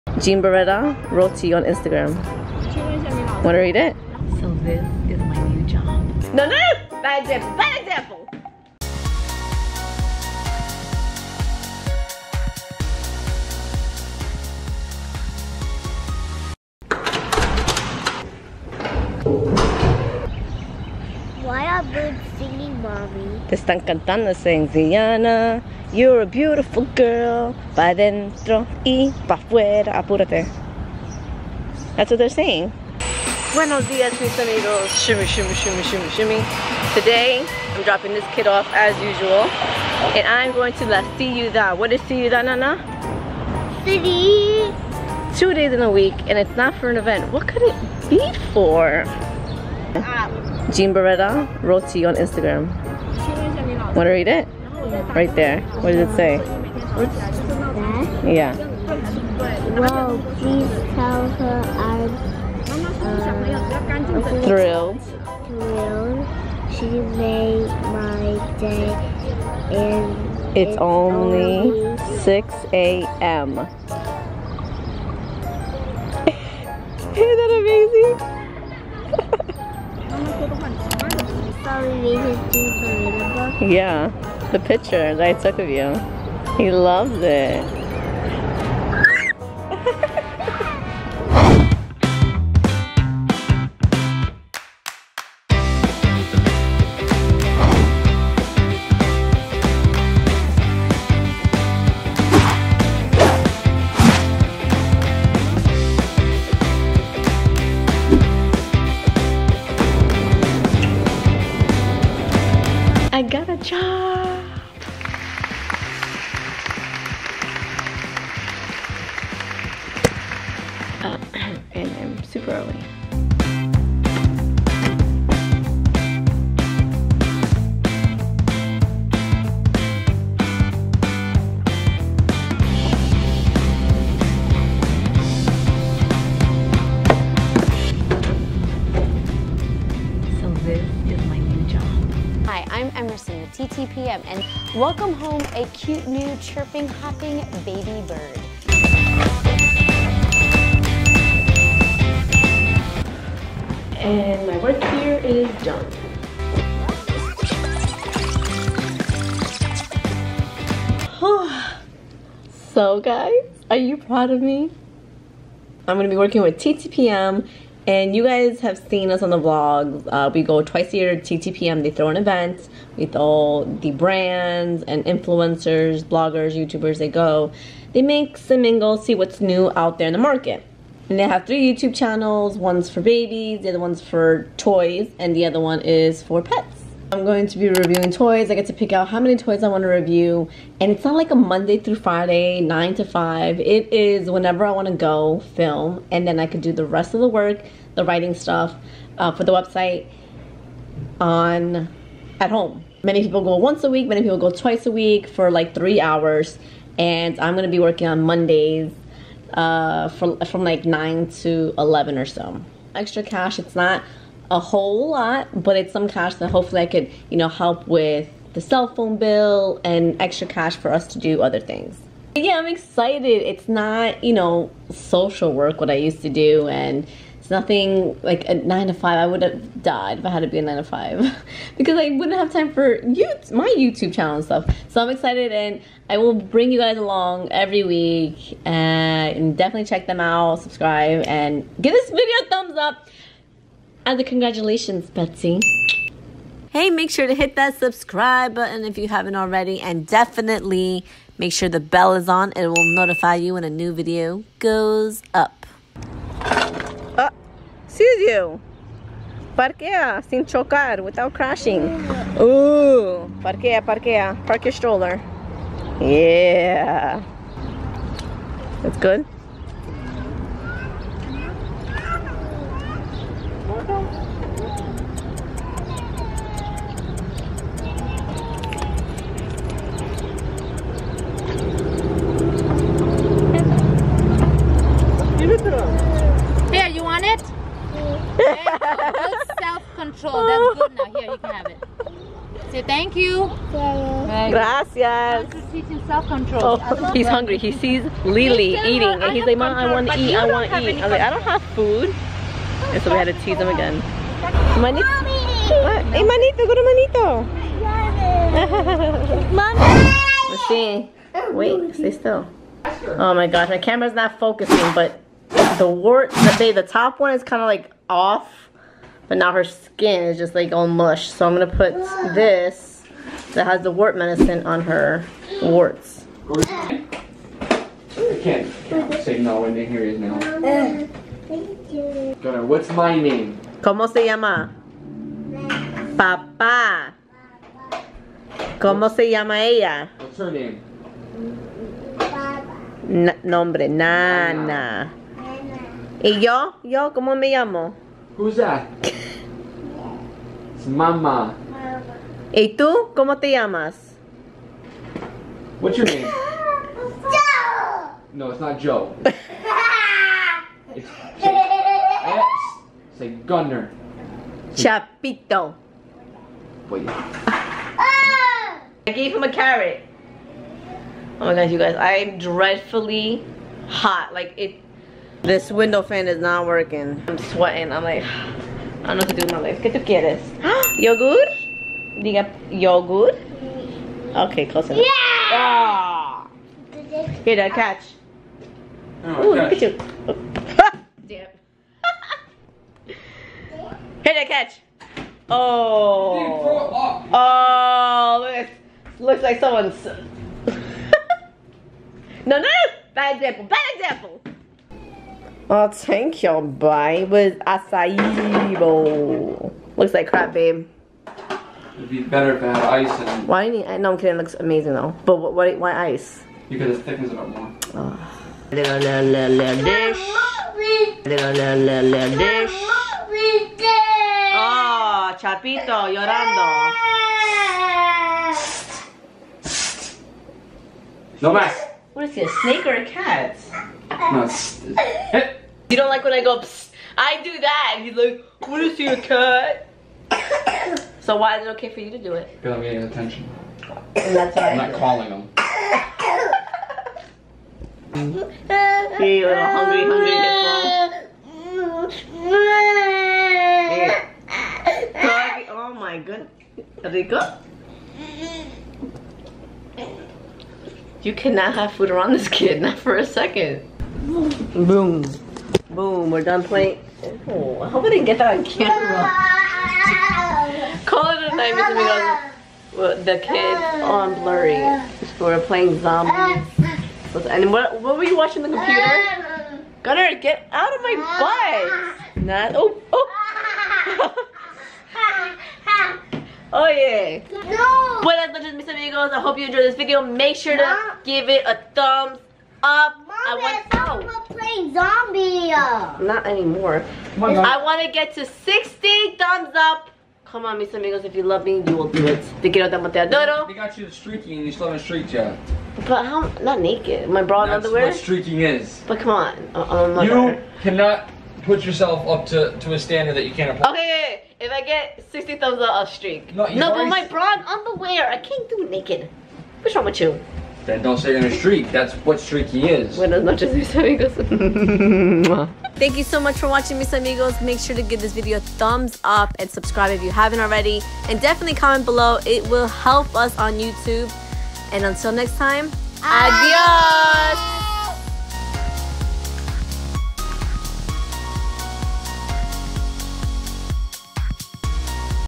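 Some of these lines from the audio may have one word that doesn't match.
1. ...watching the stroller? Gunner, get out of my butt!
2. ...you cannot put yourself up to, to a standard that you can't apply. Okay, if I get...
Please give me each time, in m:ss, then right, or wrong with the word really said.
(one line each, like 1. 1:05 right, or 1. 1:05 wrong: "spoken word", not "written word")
1. 7:58 wrong: "computer", not "stroller"
2. 8:30 right.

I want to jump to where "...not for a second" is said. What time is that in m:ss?
7:42.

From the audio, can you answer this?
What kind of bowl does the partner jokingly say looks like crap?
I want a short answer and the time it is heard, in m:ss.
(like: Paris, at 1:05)
acai bowl, at 6:47.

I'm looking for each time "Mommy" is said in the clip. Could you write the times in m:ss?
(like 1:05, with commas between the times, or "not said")
0:22, 5:09.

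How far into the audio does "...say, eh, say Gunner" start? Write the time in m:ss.
6:01.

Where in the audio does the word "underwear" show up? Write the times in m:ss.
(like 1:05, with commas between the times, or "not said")
8:27, 8:37.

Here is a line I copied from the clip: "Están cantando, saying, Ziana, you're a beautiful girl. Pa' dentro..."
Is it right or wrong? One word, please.
right.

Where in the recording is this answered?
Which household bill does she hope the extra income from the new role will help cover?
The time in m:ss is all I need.
3:37.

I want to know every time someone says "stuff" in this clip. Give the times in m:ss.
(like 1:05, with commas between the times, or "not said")
3:18, 3:54.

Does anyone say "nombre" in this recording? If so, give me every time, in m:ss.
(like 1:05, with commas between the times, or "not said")
5:43.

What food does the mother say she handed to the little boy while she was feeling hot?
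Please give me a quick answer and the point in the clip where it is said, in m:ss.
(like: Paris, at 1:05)
a carrot, at 6:09.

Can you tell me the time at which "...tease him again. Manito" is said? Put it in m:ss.
5:03.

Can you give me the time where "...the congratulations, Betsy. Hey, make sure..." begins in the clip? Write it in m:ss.
4:04.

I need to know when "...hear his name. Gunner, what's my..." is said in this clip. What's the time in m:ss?
5:29.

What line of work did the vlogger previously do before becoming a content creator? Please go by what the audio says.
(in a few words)
social work.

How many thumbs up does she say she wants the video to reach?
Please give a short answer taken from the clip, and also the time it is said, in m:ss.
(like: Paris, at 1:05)
60, at 8:17.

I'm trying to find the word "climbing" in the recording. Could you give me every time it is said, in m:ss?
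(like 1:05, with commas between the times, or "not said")
not said.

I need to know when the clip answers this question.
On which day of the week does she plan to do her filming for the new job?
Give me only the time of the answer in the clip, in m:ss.
3:27.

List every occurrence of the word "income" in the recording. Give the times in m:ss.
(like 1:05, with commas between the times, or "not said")
not said.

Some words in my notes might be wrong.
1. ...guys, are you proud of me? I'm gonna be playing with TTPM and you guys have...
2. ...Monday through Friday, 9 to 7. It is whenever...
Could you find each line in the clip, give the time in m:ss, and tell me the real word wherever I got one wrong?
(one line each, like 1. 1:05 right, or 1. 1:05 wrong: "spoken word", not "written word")
1. 2:42 wrong: "working", not "playing"
2. 3:11 wrong: "5", not "7".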